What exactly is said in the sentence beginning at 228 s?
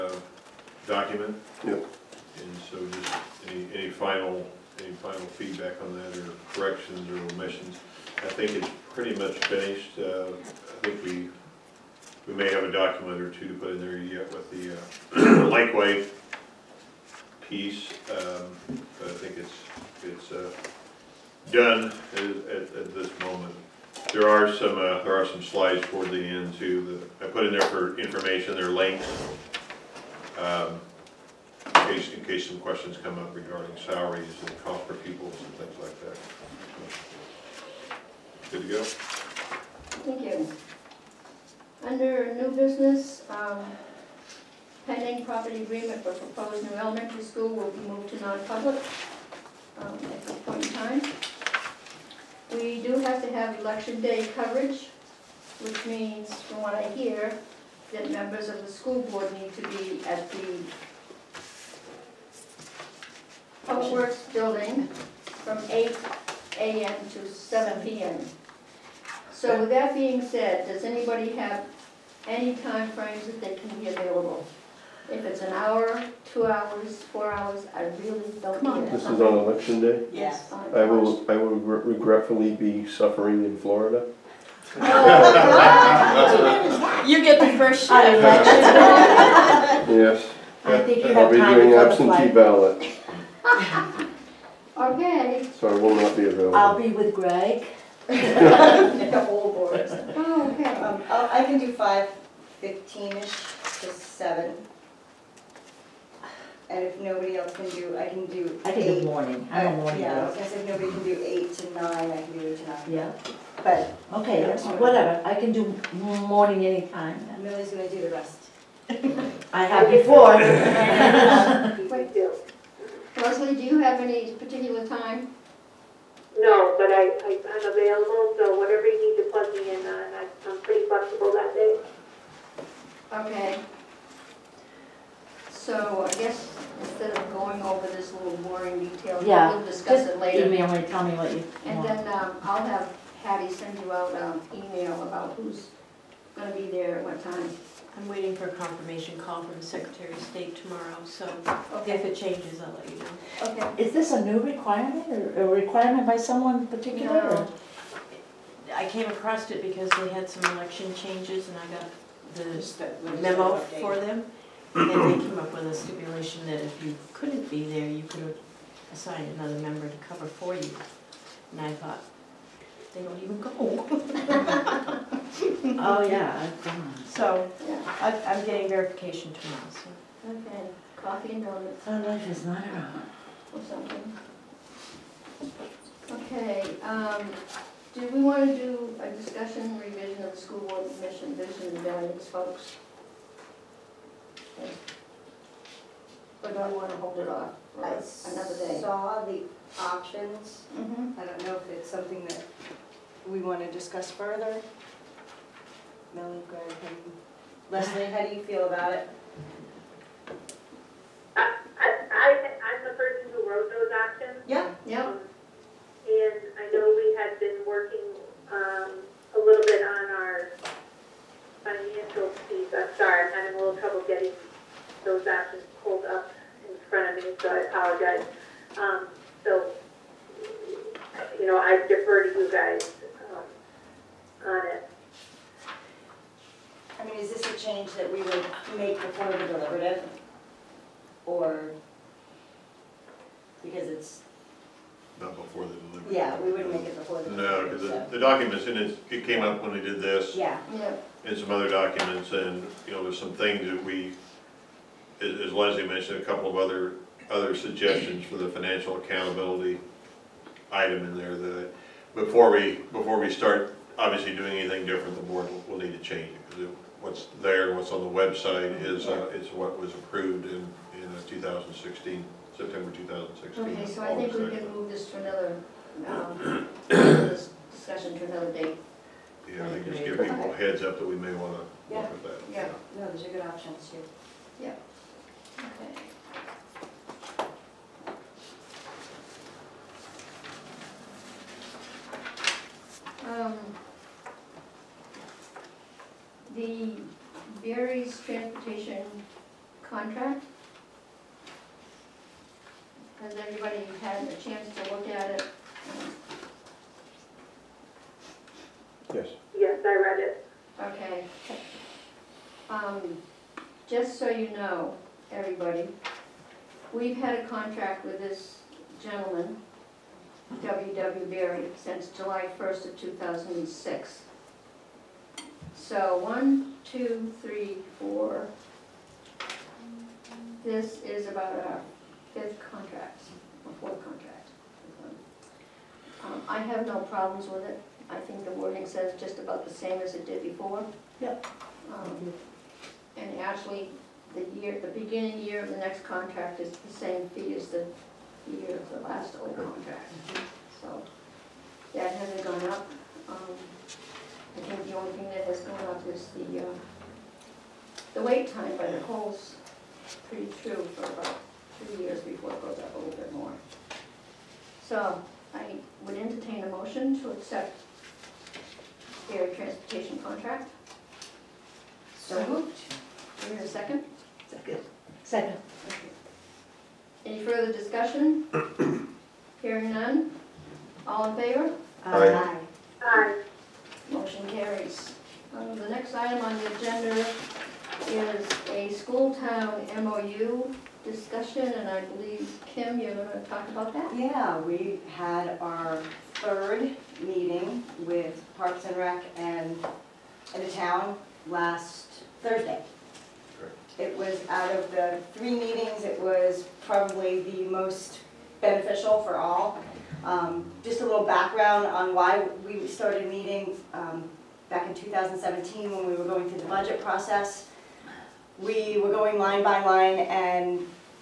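Um, so, you know, I defer to you guys um, on it.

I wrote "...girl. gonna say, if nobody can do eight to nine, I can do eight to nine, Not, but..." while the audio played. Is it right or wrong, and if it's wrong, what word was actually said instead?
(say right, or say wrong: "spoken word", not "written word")
wrong: "Yeah", not "Not".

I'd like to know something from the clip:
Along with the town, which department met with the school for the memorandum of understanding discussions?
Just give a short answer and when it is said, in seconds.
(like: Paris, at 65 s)
Parks and Rec, at 398 s.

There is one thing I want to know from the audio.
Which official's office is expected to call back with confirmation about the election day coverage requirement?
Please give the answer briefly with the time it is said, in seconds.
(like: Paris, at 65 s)
Secretary of State, at 149 s.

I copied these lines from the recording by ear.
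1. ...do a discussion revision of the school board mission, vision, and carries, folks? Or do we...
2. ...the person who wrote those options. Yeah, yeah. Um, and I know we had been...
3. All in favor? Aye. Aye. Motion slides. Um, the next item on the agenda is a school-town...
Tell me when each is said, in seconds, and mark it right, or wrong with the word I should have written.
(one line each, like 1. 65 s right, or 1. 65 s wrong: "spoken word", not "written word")
1. 188 s wrong: "values", not "carries"
2. 212 s right
3. 381 s wrong: "carries", not "slides".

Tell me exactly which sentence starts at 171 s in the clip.
And I thought, they don't even go.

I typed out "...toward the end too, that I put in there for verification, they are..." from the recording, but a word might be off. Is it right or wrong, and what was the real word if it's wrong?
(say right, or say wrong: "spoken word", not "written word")
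wrong: "information", not "verification".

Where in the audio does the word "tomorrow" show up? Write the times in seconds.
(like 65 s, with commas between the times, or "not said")
150 s, 179 s.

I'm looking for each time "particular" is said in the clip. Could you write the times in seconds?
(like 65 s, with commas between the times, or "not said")
124 s, 156 s.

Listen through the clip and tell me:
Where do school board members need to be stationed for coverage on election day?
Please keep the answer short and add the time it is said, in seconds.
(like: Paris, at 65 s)
Public Works building, at 63 s.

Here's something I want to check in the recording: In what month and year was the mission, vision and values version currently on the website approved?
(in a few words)
September 2016.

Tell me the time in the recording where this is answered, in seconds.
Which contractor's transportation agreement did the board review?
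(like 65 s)
320 s.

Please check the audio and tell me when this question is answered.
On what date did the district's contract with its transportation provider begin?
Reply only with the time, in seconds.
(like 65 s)
322 s.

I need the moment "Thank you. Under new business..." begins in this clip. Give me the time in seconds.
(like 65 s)
38 s.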